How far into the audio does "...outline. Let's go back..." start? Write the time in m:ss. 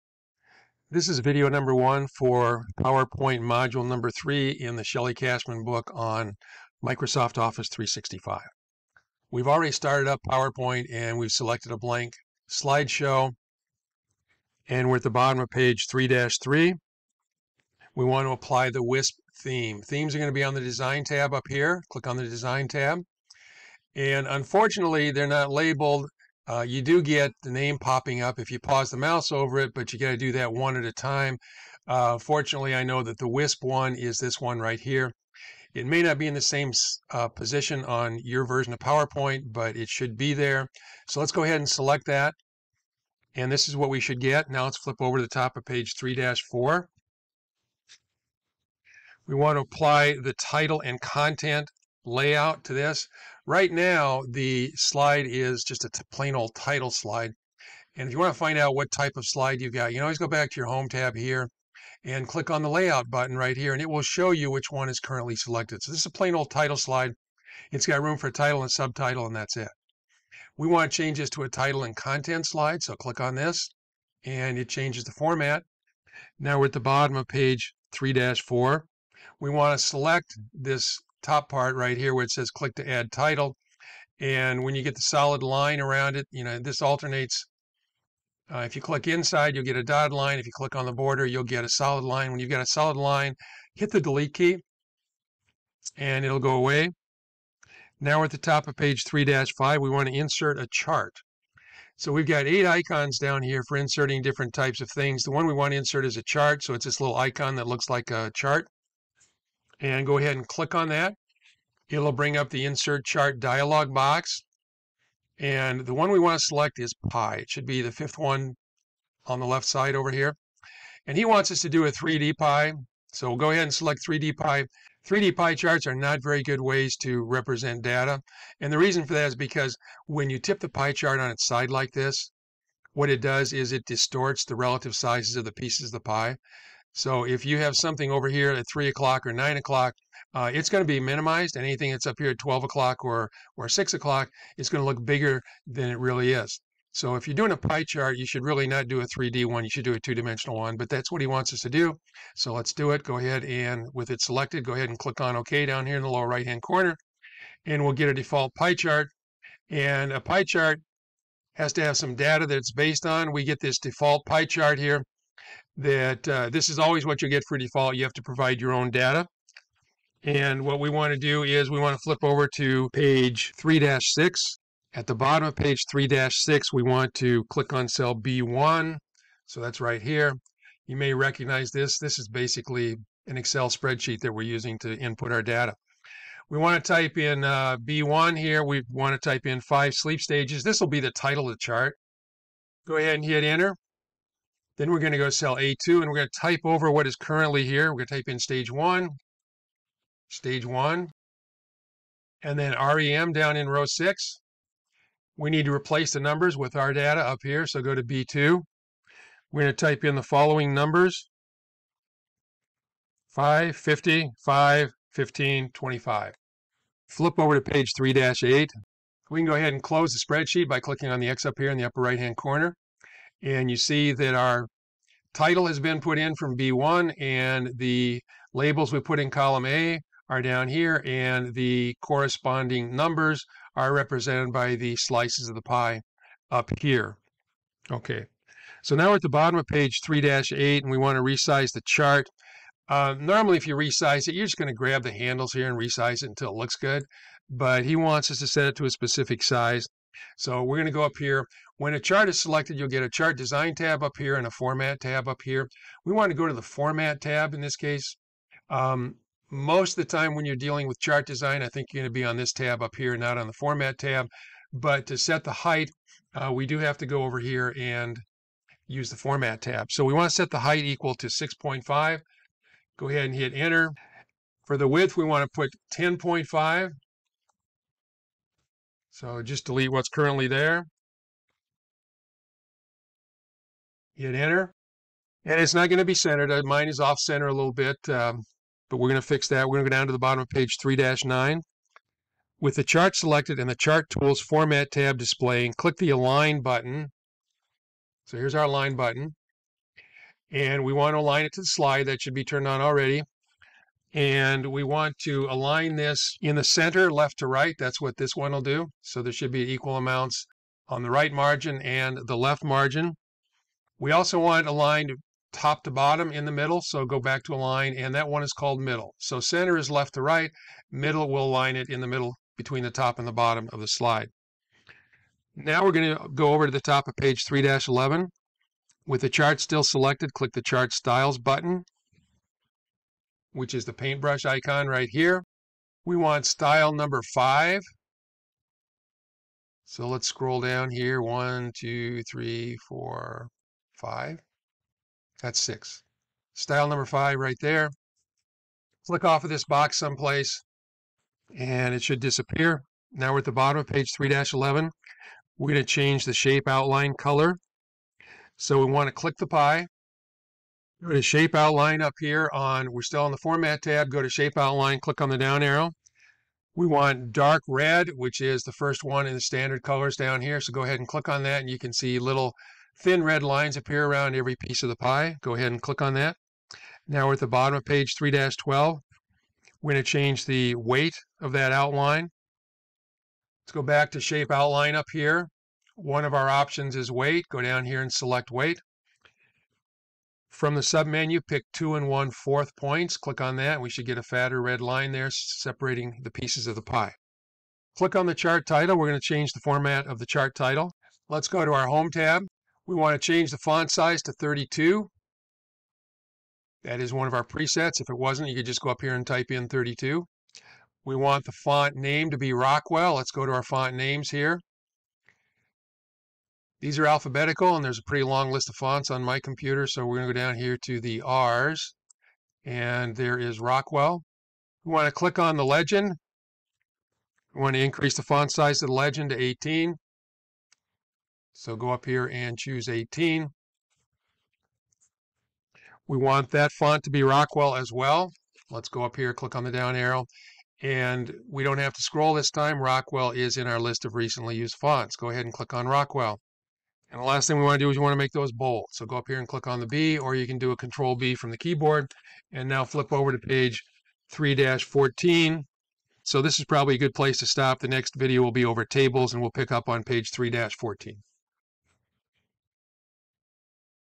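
6:21.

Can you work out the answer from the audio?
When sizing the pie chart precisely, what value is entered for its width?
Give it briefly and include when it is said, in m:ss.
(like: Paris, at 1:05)
10.5, at 4:35.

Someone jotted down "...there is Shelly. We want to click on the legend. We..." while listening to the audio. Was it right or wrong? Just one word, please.
wrong.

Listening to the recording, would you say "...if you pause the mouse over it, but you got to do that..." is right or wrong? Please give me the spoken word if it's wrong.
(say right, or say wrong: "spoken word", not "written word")
right.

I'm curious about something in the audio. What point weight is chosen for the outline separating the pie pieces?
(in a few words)
2 1/4 points.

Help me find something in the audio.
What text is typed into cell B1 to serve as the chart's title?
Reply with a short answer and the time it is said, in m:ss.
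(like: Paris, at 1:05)
five sleep stages, at 3:09.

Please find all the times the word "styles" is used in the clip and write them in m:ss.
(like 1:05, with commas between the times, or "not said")
5:30, 5:36, 5:46.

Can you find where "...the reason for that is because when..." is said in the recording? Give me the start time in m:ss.
2:08.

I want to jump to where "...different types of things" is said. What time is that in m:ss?
1:44.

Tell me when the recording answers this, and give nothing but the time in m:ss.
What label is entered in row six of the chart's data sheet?
3:22.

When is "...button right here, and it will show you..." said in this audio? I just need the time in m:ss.
1:03.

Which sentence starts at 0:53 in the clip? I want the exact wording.
Right now, the slide is just a plain old title slide.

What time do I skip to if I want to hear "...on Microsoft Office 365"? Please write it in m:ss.
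0:05.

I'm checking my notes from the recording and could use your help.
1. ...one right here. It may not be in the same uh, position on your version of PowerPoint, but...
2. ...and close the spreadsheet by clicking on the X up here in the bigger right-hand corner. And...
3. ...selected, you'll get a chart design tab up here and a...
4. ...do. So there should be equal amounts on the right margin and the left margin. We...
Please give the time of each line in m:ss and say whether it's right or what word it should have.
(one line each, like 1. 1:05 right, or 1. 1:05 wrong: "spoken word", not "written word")
1. 0:34 right
2. 3:39 wrong: "upper", not "bigger"
3. 4:12 right
4. 5:08 right.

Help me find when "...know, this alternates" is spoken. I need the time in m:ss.
1:26.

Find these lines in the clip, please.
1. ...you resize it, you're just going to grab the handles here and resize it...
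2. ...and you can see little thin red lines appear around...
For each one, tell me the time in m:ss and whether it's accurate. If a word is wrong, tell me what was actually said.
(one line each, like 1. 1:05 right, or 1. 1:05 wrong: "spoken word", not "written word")
1. 4:03 right
2. 6:11 right.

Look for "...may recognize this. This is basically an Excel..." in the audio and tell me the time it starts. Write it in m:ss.
3:00.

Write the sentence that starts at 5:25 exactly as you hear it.
Now we're going to go over to the top of page 3-11.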